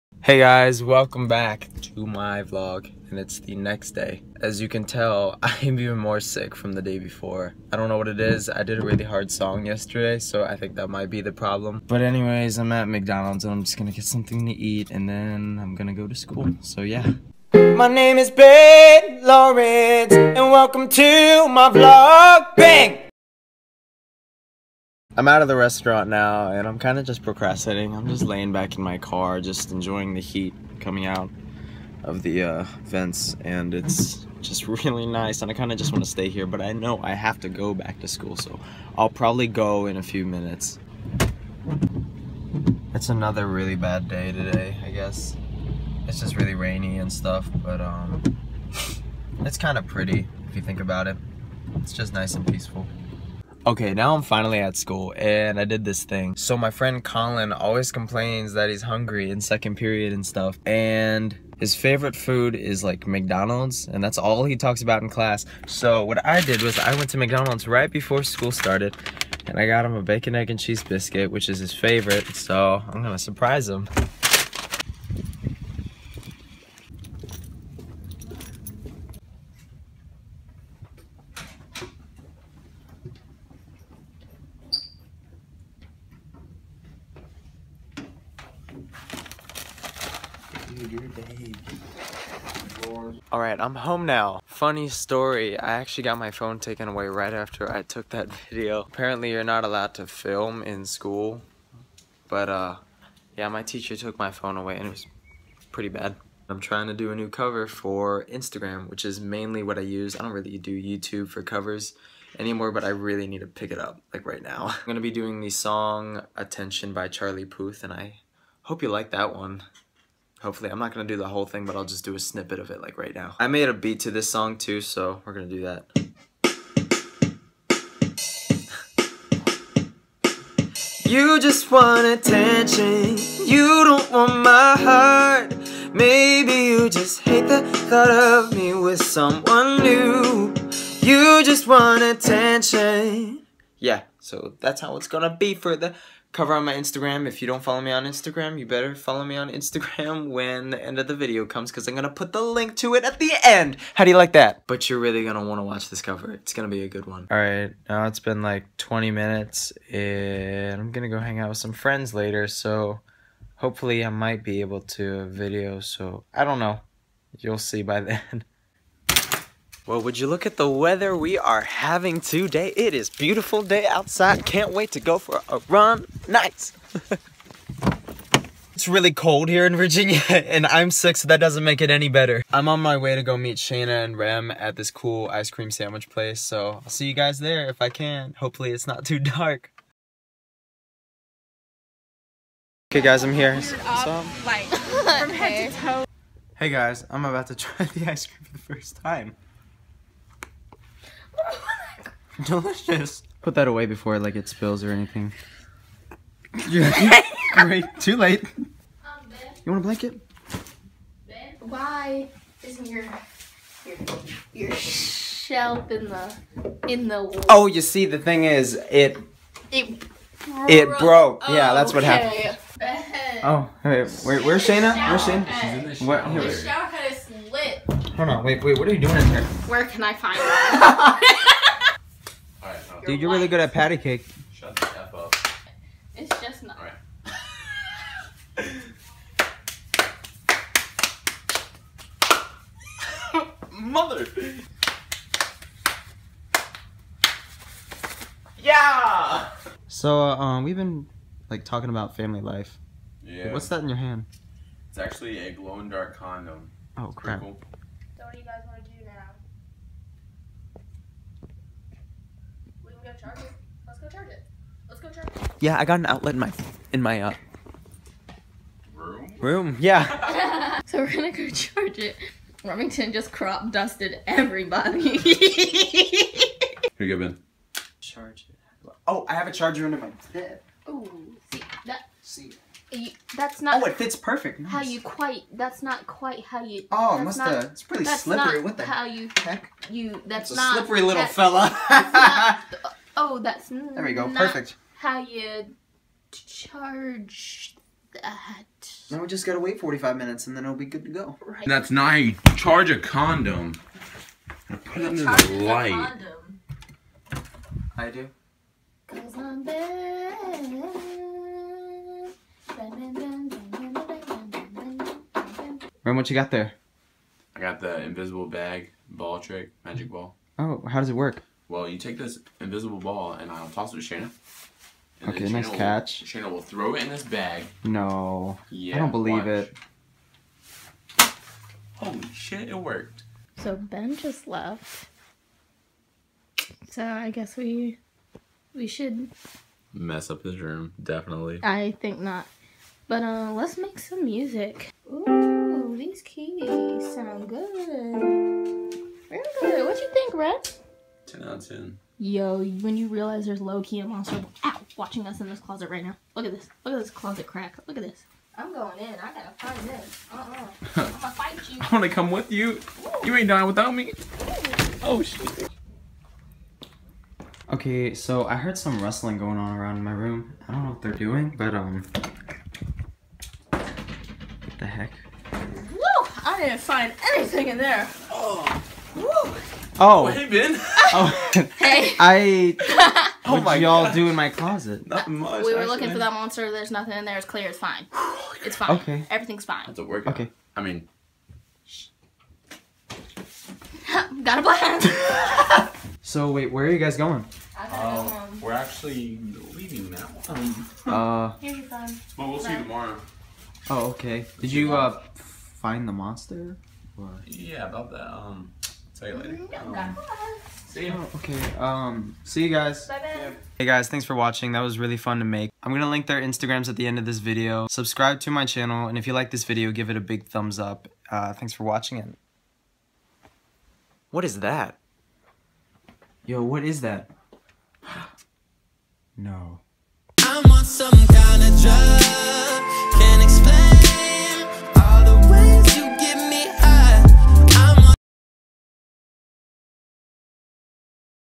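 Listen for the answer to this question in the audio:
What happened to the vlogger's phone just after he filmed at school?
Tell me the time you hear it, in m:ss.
1:36.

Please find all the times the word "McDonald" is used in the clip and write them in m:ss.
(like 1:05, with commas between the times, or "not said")
0:12, 1:03, 1:07.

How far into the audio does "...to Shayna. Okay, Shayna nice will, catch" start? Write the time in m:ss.
5:24.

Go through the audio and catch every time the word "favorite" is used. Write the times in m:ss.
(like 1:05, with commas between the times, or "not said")
1:01, 1:11.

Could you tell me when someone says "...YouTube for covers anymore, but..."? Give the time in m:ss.
1:50.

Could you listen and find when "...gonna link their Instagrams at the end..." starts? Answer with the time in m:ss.
6:55.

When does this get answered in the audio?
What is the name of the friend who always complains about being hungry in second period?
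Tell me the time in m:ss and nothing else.
0:57.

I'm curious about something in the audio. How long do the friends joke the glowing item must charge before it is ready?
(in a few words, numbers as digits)
45 minutes.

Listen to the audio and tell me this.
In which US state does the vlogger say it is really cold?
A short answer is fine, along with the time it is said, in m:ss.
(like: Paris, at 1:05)
Virginia, at 2:59.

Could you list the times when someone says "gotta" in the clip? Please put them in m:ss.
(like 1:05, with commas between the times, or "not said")
4:59, 5:59.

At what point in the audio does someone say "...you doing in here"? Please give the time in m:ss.
3:48.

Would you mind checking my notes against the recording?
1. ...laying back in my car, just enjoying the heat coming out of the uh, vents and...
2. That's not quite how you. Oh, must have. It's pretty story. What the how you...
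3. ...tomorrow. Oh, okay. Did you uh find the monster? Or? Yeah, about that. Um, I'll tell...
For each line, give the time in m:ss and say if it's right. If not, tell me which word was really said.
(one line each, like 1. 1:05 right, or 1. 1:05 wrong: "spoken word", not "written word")
1. 0:28 right
2. 4:45 wrong: "slippery", not "story"
3. 6:42 right.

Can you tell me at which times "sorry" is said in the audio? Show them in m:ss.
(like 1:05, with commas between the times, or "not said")
not said.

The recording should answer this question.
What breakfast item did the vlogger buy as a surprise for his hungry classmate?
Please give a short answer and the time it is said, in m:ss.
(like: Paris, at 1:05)
bacon, egg, and cheese biscuit, at 1:10.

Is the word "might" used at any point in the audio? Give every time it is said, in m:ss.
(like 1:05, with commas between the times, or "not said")
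0:10, 2:44.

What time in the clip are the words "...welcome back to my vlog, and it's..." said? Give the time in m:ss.
0:00.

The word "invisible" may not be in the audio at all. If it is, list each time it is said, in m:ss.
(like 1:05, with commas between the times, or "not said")
5:18, 5:22.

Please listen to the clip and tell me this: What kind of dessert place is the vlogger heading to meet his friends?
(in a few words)
ice cream sandwich place.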